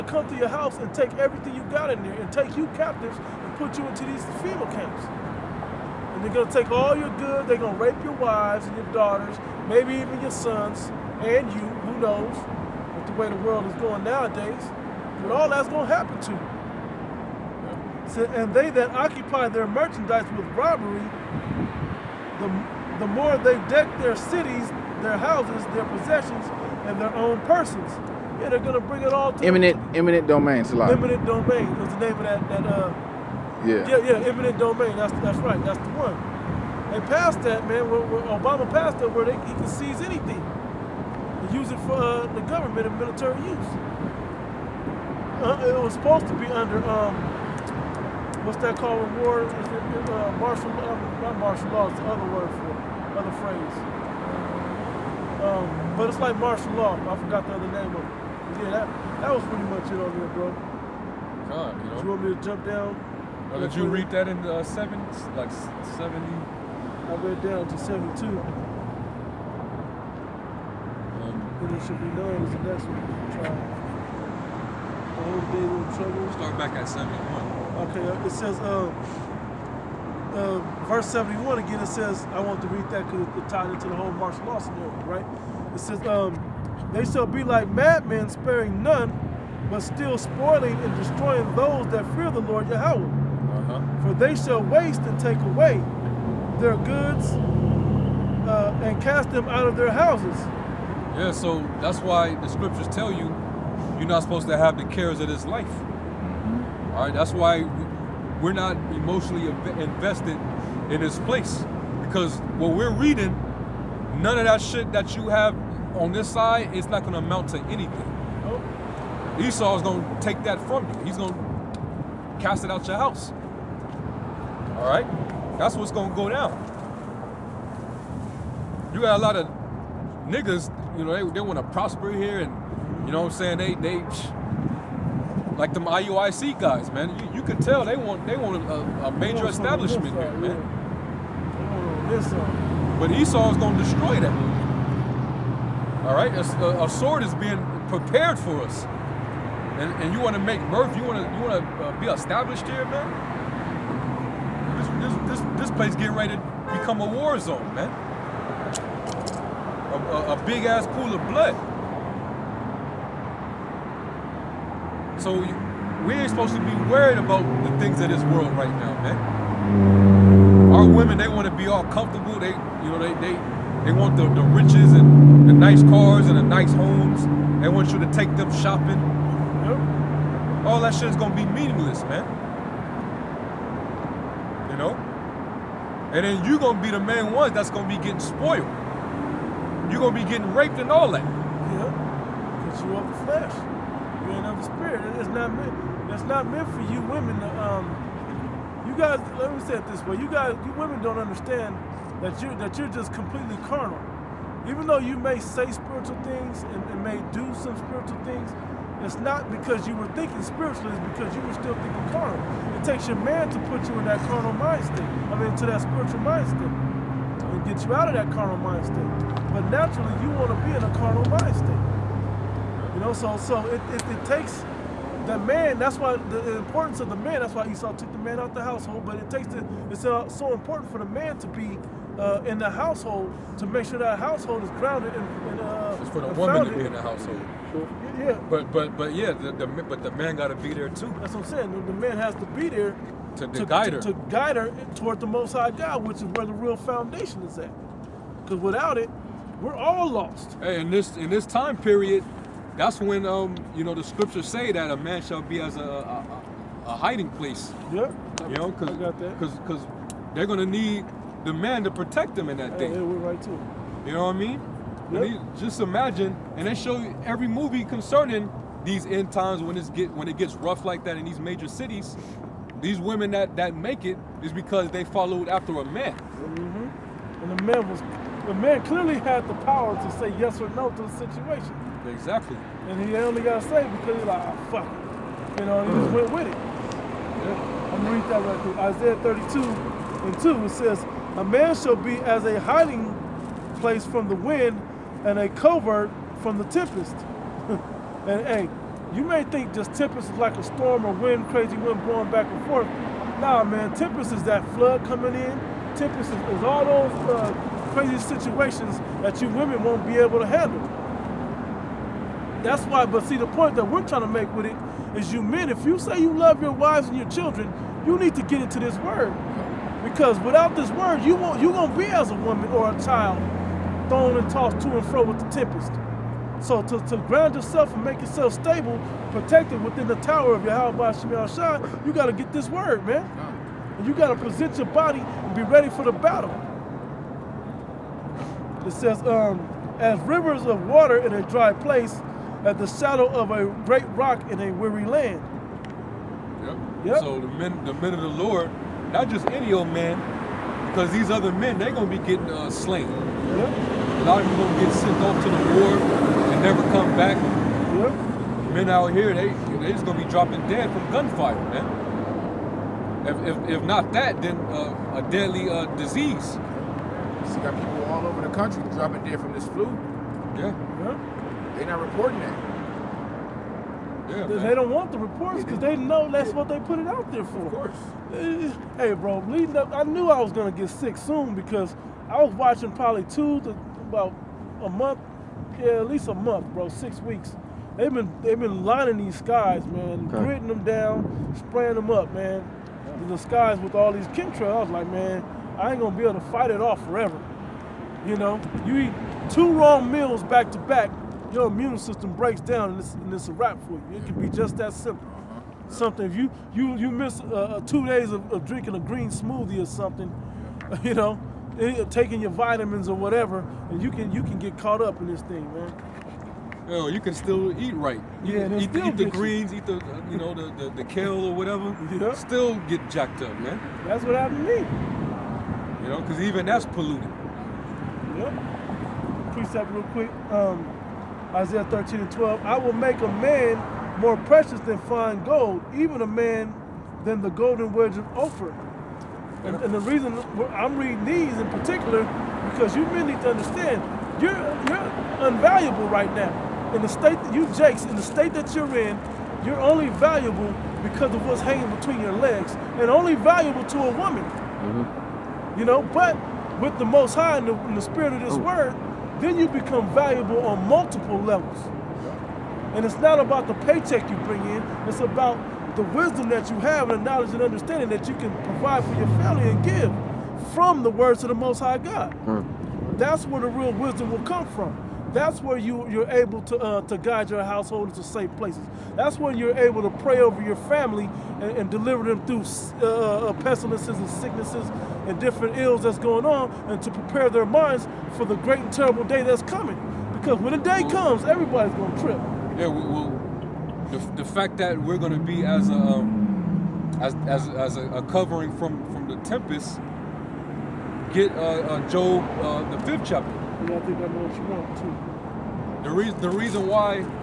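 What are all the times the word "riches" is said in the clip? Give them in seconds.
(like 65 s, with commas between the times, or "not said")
174 s.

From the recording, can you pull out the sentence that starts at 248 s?
Because without it, we're all lost.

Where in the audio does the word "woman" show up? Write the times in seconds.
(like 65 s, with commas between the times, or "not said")
236 s, 322 s, 454 s.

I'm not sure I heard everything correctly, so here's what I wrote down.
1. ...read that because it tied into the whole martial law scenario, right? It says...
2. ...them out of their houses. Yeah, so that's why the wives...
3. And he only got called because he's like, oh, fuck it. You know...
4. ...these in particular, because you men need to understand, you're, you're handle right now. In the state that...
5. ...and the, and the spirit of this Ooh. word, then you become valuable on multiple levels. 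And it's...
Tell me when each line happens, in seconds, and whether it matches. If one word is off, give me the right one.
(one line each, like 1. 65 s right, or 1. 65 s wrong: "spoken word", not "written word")
1. 82 s right
2. 99 s wrong: "scriptures", not "wives"
3. 282 s wrong: "saved", not "called"
4. 441 s wrong: "unvaluable", not "handle"
5. 457 s right.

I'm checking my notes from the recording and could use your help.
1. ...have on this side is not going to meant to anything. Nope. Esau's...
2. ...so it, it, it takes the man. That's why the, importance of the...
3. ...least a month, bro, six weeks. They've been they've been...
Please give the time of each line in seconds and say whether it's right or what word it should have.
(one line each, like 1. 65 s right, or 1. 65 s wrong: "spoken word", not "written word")
1. 115 s wrong: "amount", not "meant"
2. 223 s right
3. 386 s right.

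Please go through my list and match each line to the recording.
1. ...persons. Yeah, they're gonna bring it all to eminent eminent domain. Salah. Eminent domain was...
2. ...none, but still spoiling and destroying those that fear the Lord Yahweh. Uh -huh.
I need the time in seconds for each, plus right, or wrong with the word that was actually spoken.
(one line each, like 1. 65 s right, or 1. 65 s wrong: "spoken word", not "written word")
1. 27 s right
2. 88 s right.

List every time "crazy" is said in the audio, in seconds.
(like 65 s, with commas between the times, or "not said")
301 s, 307 s.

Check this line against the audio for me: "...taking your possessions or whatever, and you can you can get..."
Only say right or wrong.
wrong.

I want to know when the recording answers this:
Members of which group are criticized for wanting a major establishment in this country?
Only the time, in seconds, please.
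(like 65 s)
135 s.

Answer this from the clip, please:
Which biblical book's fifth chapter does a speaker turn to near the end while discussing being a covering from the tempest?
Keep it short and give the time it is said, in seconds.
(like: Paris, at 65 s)
Job, at 502 s.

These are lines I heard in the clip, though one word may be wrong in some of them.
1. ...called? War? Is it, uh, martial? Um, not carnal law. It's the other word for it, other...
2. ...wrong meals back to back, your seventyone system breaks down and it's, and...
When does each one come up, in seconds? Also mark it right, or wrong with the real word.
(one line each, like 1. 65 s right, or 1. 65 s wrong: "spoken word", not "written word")
1. 48 s wrong: "martial", not "carnal"
2. 399 s wrong: "immune", not "seventyone".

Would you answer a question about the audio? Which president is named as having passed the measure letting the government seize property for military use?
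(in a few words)
Obama.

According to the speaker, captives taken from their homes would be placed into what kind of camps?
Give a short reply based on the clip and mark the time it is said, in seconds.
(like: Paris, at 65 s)
FEMA camps, at 4 s.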